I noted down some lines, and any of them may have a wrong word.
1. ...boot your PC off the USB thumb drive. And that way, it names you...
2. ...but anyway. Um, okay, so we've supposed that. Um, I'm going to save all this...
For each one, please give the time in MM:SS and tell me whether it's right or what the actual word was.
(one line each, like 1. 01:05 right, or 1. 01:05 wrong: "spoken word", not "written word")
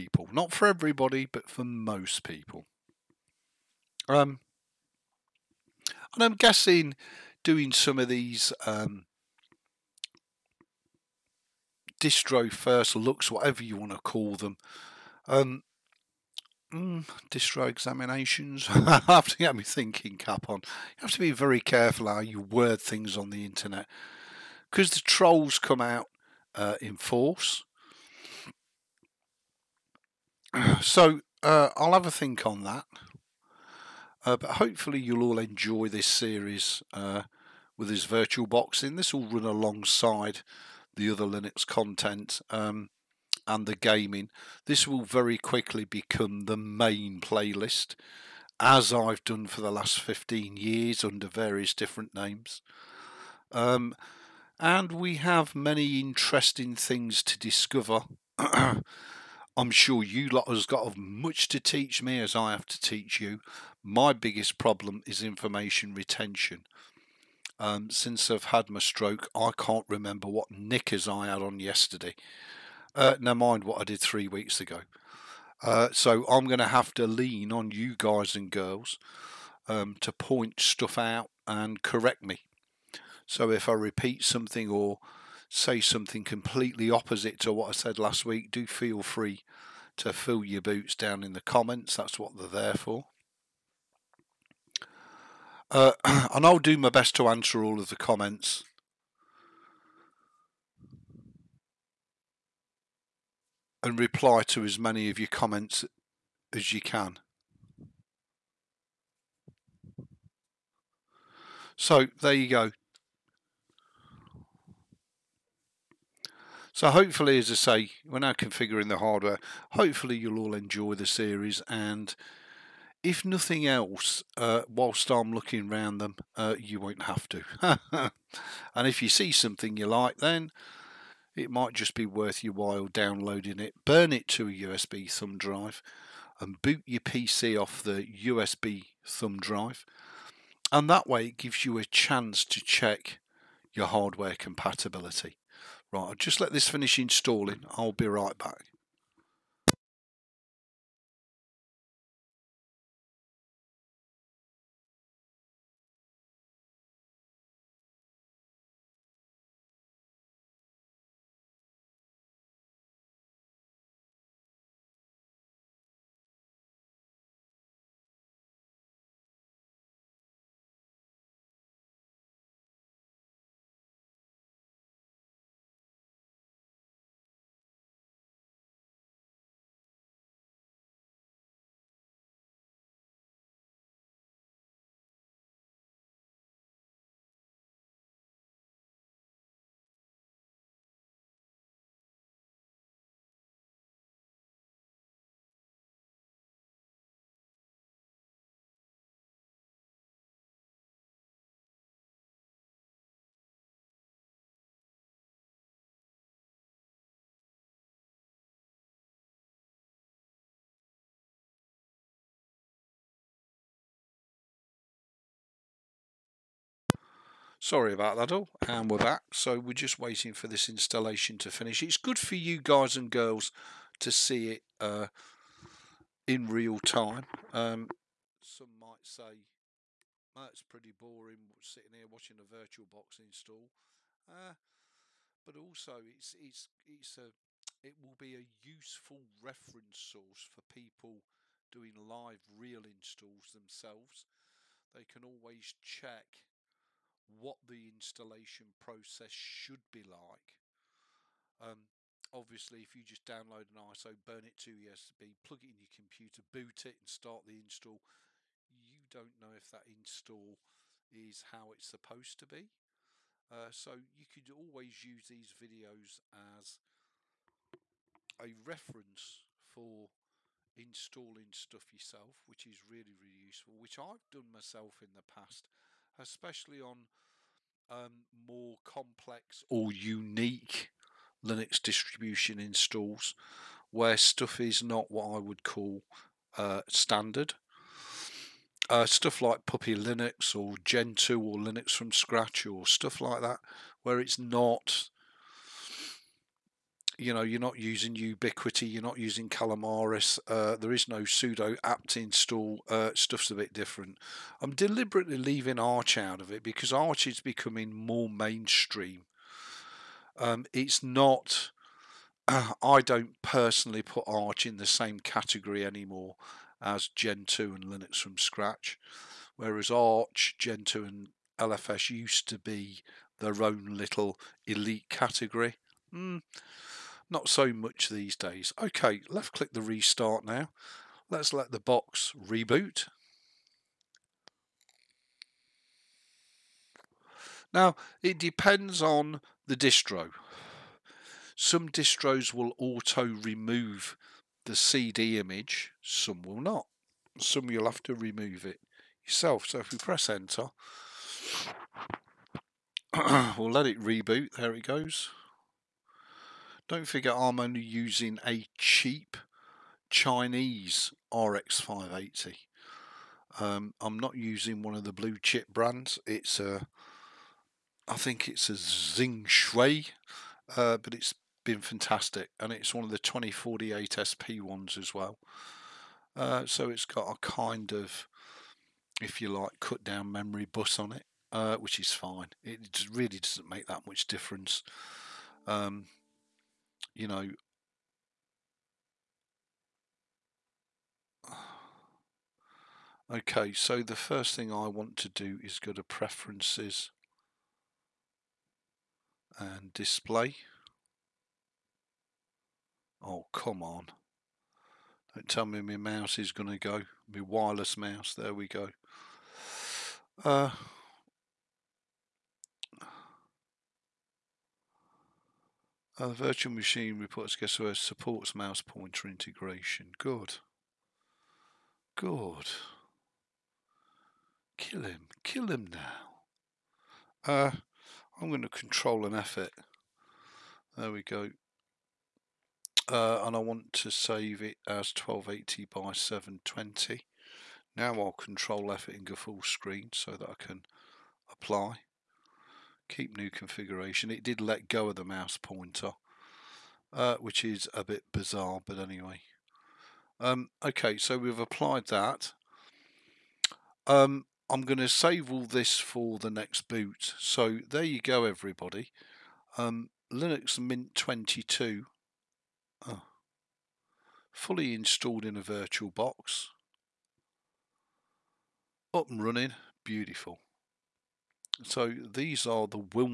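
1. 02:16 wrong: "gives", not "names"
2. 07:28 wrong: "applied", not "supposed".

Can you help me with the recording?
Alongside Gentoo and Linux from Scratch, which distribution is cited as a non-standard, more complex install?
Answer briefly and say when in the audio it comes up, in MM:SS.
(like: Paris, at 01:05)
Puppy Linux, at 04:49.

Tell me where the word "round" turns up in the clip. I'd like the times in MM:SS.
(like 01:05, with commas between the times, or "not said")
02:05.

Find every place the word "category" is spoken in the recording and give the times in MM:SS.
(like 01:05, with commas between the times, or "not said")
05:15, 05:25.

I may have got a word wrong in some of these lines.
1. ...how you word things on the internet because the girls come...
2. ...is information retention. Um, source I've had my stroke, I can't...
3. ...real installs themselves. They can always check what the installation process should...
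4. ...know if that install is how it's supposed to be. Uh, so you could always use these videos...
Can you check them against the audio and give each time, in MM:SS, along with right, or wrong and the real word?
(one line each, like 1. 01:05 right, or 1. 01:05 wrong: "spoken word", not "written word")
1. 00:22 wrong: "trolls", not "girls"
2. 01:05 wrong: "since", not "source"
3. 04:02 right
4. 04:19 right.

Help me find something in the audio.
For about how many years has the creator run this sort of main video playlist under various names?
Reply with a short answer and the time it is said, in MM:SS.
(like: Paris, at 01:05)
15, at 00:49.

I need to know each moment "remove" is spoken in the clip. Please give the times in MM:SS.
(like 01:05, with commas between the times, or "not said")
05:43, 05:48.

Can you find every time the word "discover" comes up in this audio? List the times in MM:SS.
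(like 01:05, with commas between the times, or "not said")
00:57.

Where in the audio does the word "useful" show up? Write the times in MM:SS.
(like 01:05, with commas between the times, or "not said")
03:58, 04:33.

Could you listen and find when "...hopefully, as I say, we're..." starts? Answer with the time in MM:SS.
01:56.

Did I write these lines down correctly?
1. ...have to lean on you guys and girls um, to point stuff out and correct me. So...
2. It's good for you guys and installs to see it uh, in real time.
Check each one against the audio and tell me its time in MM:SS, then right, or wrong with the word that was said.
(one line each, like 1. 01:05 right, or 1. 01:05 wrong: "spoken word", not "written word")
1. 01:16 right
2. 03:41 wrong: "girls", not "installs".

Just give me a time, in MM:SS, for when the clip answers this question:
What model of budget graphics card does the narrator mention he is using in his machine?
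06:01.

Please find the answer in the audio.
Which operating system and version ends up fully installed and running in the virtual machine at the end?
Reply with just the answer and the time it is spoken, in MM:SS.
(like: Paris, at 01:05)
Linux Mint 22, at 07:40.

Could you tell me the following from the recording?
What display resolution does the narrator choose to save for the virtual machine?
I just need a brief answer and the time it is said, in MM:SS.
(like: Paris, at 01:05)
1280 by 720, at 07:15.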